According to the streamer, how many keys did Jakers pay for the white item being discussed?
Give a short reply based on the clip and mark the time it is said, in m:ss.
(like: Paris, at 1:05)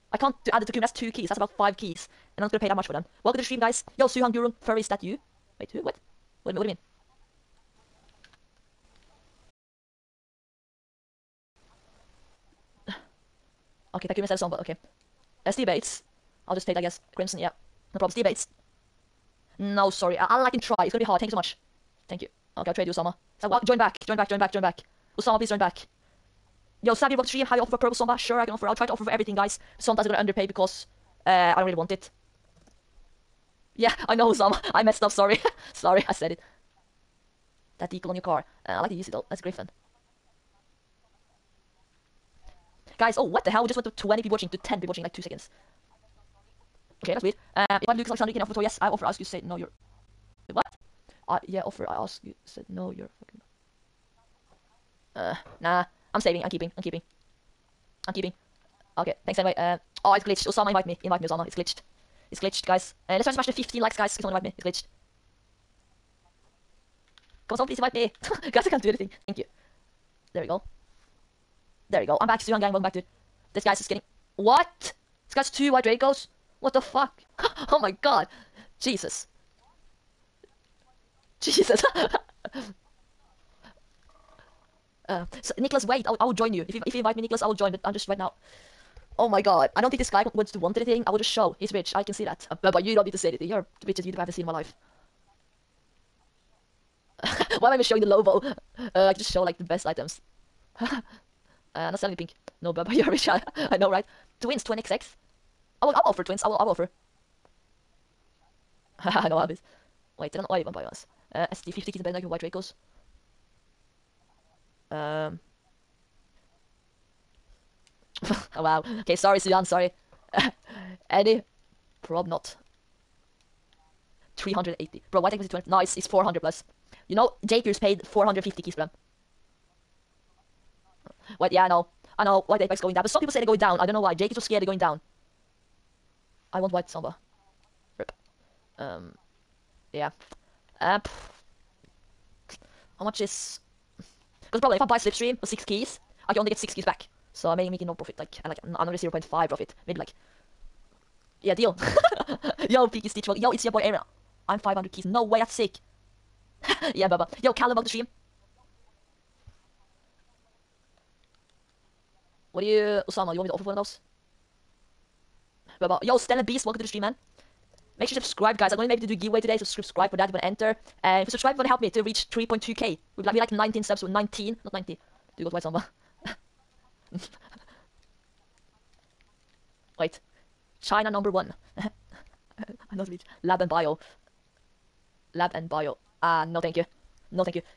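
450, at 2:08.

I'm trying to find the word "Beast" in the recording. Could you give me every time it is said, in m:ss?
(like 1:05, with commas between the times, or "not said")
2:46.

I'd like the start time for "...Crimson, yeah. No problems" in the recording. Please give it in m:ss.
0:17.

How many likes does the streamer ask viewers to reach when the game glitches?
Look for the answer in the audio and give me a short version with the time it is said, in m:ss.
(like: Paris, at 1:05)
15, at 1:03.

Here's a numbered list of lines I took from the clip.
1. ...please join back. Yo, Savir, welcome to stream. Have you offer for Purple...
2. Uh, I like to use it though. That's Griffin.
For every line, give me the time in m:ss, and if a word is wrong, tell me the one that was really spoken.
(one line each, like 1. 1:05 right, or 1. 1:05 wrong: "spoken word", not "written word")
1. 0:25 right
2. 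0:38 right.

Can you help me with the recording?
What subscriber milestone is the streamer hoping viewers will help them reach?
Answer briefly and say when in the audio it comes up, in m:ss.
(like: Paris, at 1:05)
3.2k, at 2:52.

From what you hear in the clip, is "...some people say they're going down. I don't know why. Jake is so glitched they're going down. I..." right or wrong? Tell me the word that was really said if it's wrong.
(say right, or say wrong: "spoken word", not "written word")
wrong: "scared", not "glitched".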